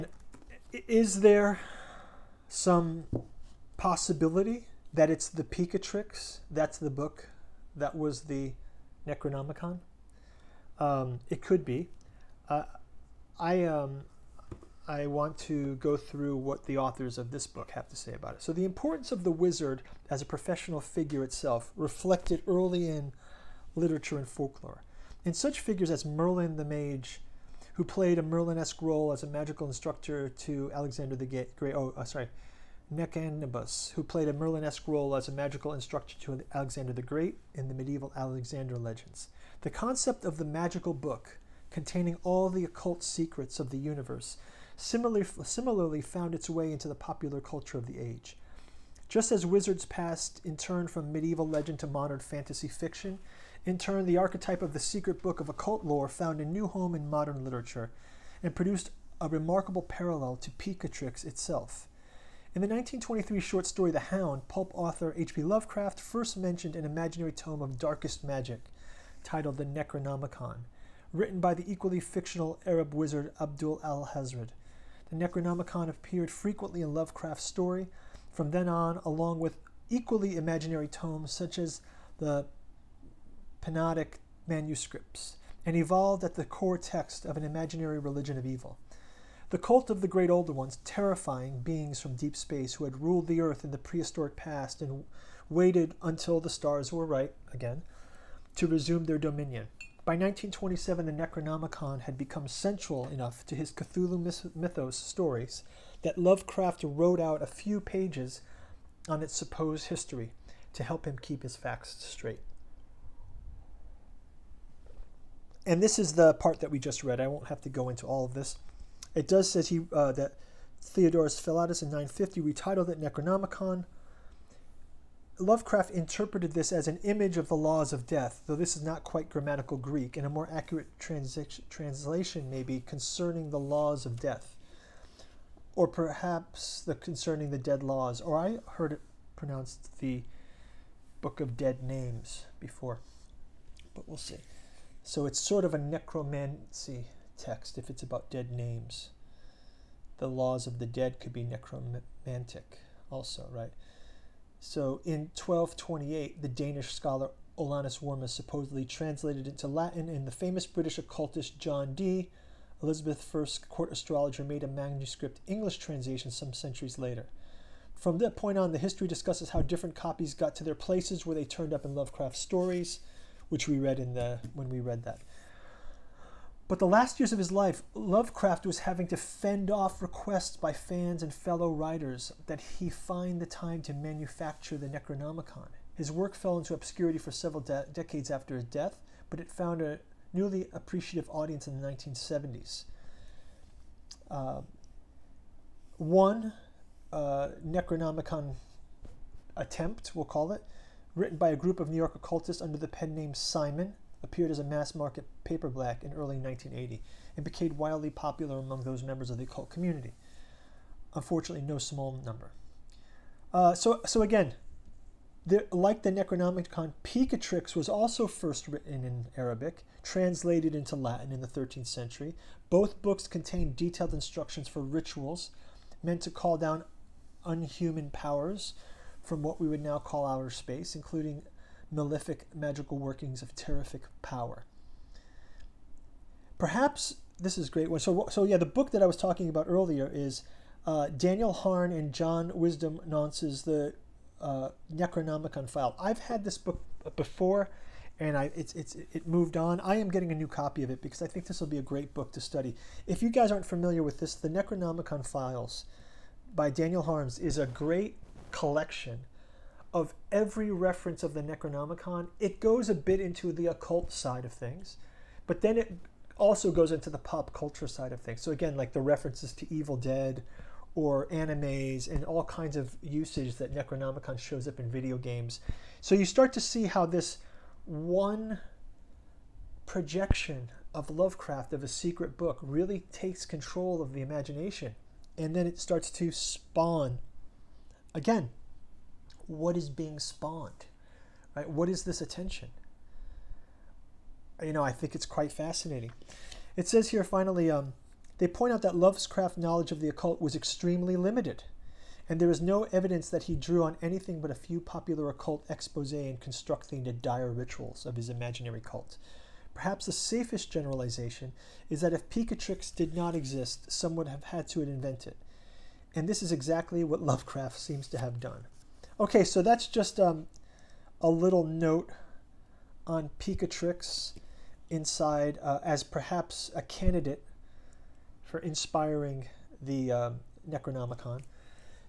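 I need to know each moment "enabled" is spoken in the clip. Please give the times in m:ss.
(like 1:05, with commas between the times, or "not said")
not said.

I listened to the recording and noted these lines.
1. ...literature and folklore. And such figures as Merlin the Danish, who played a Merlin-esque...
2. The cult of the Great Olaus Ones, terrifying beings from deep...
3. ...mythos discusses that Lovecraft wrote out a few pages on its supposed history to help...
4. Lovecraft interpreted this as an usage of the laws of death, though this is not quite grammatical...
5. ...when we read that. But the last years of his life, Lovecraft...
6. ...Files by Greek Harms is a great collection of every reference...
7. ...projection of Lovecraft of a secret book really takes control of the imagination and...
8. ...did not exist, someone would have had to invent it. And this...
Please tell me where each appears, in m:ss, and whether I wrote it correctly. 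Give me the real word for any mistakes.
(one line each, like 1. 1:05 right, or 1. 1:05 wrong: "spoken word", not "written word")
1. 0:23 wrong: "Mage", not "Danish"
2. 1:29 wrong: "Older", not "Olaus"
3. 1:44 wrong: "stories", not "discusses"
4. 2:05 wrong: "image", not "usage"
5. 2:54 right
6. 4:15 wrong: "Daniel", not "Greek"
7. 4:39 right
8. 5:12 right.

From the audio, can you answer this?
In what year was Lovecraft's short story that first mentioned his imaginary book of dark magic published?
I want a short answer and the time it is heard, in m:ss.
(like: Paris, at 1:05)
1923, at 1:02.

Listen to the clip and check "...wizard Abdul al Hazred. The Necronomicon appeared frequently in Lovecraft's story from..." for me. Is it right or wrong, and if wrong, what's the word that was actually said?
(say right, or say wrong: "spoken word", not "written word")
right.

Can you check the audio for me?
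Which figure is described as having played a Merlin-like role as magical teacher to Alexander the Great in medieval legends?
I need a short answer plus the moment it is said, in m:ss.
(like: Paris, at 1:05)
Nectanebus, at 0:32.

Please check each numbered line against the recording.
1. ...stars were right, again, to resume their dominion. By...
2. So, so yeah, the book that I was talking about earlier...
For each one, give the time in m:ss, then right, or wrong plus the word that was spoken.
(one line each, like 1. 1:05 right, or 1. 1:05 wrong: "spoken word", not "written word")
1. 1:36 right
2. 3:57 right.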